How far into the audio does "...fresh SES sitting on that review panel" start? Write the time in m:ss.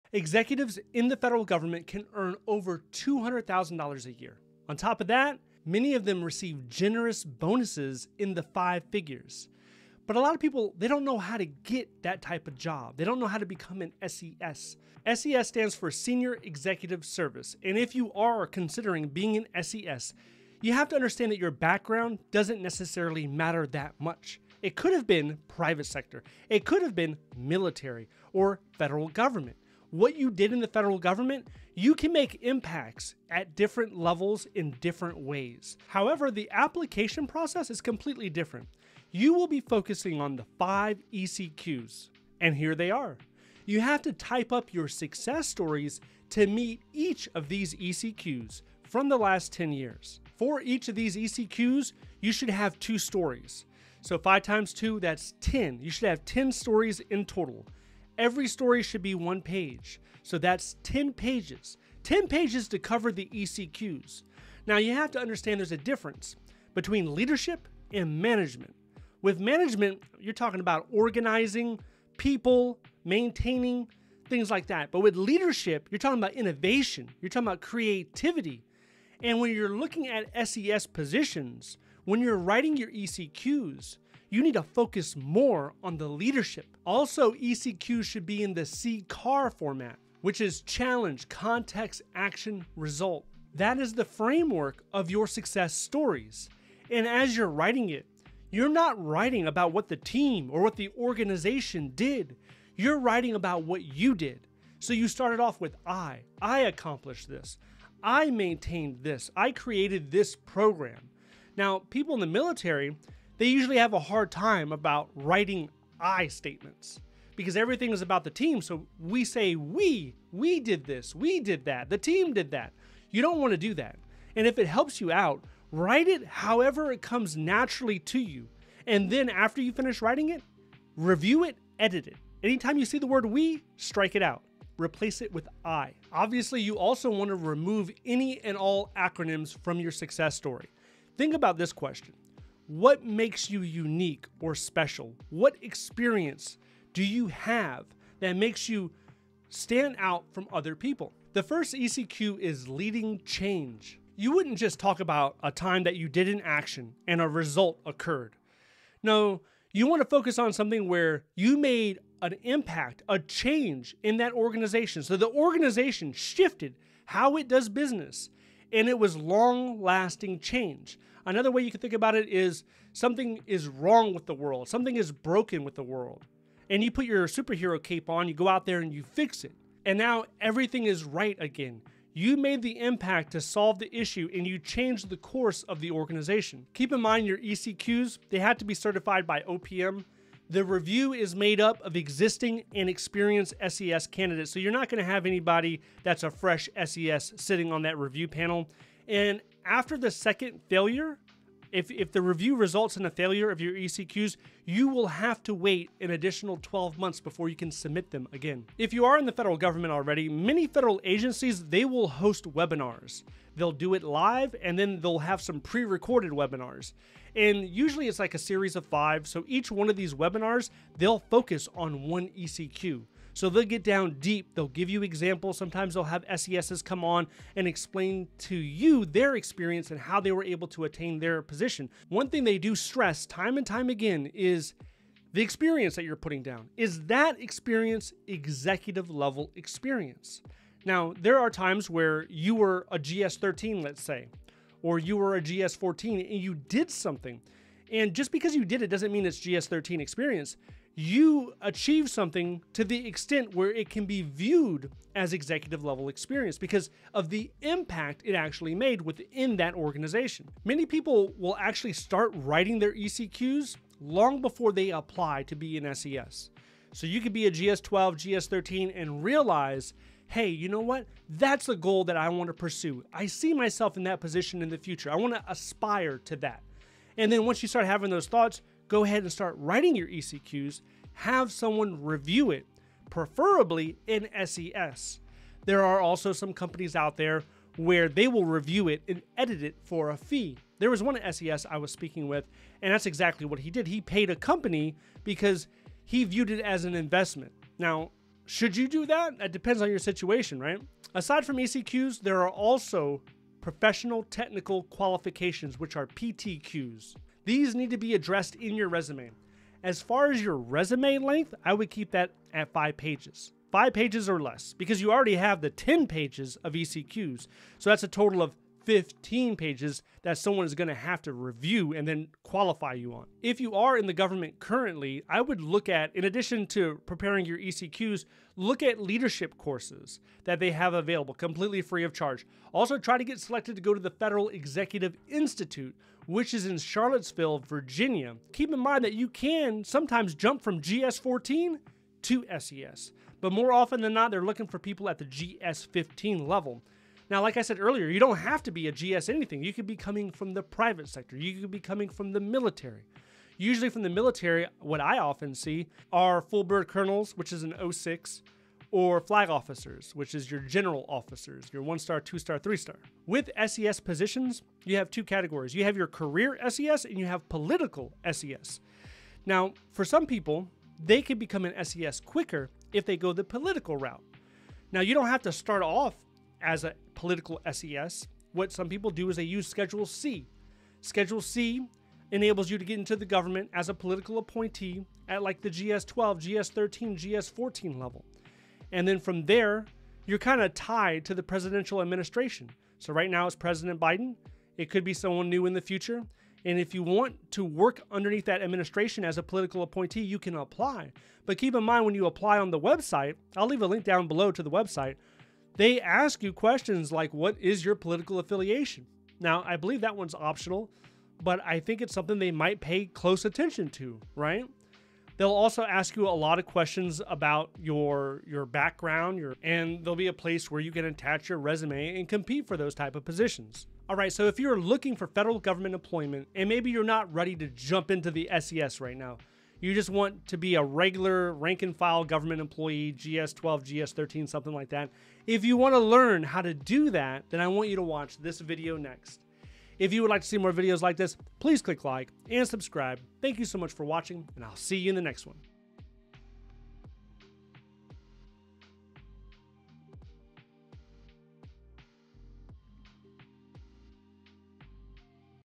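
3:16.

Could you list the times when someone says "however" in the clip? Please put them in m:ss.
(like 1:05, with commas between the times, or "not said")
0:35, 2:06.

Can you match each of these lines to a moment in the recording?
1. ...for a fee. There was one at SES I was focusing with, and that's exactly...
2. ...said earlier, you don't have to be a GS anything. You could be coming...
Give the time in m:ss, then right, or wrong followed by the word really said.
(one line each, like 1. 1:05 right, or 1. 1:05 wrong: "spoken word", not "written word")
1. 4:49 wrong: "speaking", not "focusing"
2. 5:47 right.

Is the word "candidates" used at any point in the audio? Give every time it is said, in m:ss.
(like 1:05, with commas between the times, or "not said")
3:14.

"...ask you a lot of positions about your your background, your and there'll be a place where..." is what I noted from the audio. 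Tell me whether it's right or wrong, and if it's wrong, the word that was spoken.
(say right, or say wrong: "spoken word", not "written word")
wrong: "questions", not "positions".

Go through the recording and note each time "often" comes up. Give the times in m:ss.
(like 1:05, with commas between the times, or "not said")
5:43, 5:55.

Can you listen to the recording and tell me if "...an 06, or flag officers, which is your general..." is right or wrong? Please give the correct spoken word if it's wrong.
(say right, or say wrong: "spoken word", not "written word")
right.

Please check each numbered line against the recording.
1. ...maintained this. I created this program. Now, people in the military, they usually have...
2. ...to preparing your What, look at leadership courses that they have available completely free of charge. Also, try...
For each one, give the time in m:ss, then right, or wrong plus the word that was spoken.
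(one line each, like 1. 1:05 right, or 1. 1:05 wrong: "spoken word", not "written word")
1. 1:48 right
2. 5:26 wrong: "ECQs", not "What".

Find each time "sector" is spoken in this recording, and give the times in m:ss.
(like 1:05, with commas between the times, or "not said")
0:25, 5:51.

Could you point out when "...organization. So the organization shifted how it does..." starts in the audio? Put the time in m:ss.
2:44.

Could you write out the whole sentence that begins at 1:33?
That is the framework of your success stories.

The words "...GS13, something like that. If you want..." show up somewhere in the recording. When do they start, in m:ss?
7:13.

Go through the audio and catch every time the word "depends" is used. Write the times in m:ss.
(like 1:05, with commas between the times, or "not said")
4:59.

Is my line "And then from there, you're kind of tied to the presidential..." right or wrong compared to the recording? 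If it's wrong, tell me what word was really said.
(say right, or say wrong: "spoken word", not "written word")
right.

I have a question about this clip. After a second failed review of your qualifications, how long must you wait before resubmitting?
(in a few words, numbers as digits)
12 months.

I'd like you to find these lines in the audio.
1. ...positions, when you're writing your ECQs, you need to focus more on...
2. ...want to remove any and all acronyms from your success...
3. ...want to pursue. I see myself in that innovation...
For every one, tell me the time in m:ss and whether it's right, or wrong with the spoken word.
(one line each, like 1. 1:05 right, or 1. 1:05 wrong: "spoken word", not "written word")
1. 1:20 right
2. 2:17 right
3. 4:32 wrong: "position", not "innovation".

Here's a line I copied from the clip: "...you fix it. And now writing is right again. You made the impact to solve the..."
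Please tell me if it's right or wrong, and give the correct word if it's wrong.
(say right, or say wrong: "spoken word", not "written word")
wrong: "everything", not "writing".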